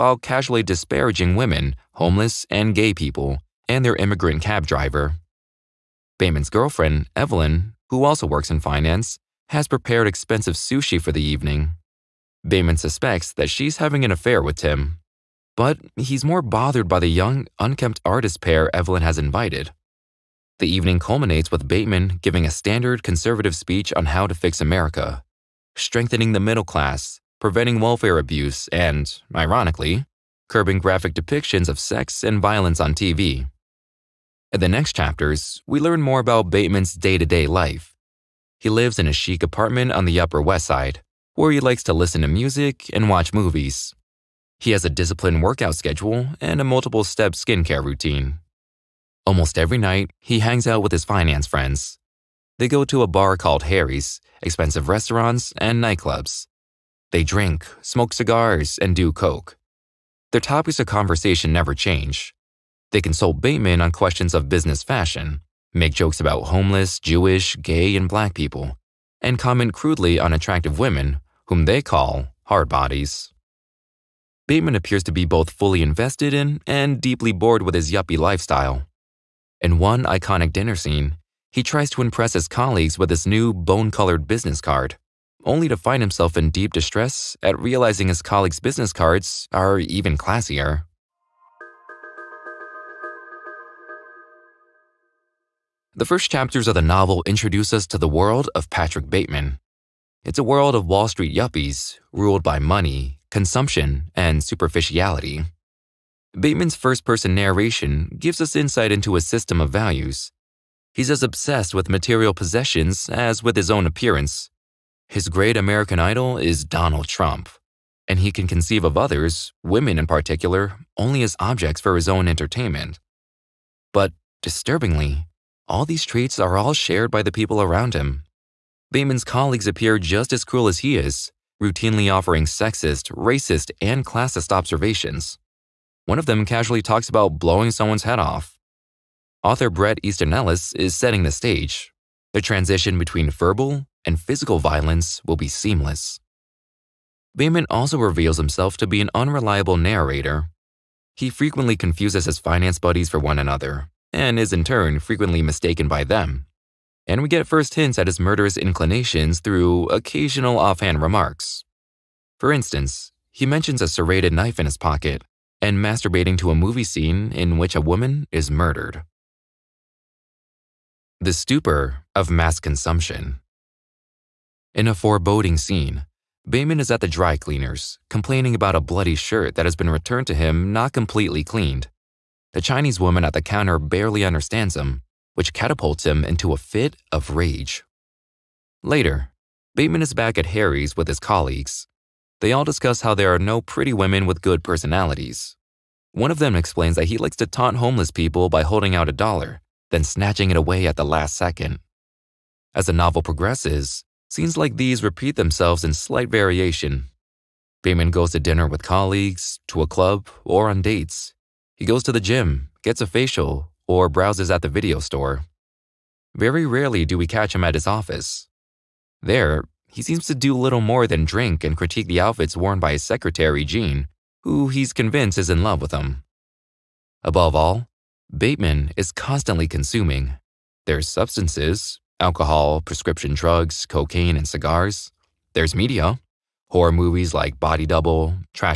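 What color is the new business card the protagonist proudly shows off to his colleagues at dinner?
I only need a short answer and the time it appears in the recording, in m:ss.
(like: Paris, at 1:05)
Bone-colored, at 1:23.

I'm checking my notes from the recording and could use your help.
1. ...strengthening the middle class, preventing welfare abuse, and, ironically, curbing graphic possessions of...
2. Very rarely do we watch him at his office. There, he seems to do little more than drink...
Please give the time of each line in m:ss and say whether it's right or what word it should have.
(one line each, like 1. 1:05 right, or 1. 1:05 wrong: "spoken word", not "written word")
1. 0:25 wrong: "depictions", not "possessions"
2. 3:36 wrong: "catch", not "watch".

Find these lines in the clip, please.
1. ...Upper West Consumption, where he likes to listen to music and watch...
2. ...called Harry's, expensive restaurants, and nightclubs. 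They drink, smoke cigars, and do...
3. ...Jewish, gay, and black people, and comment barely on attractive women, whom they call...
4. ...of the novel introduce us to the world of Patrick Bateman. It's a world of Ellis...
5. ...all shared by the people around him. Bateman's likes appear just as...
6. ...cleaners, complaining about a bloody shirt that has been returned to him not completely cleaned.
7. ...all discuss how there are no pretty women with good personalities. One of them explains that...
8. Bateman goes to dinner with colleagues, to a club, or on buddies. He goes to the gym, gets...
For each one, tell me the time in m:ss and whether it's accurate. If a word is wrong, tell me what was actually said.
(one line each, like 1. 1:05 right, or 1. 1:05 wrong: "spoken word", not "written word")
1. 0:40 wrong: "Side", not "Consumption"
2. 0:53 right
3. 1:06 wrong: "crudely", not "barely"
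4. 1:36 wrong: "Wall", not "Ellis"
5. 2:06 wrong: "colleagues", not "likes"
6. 2:57 right
7. 3:12 right
8. 3:27 wrong: "dates", not "buddies".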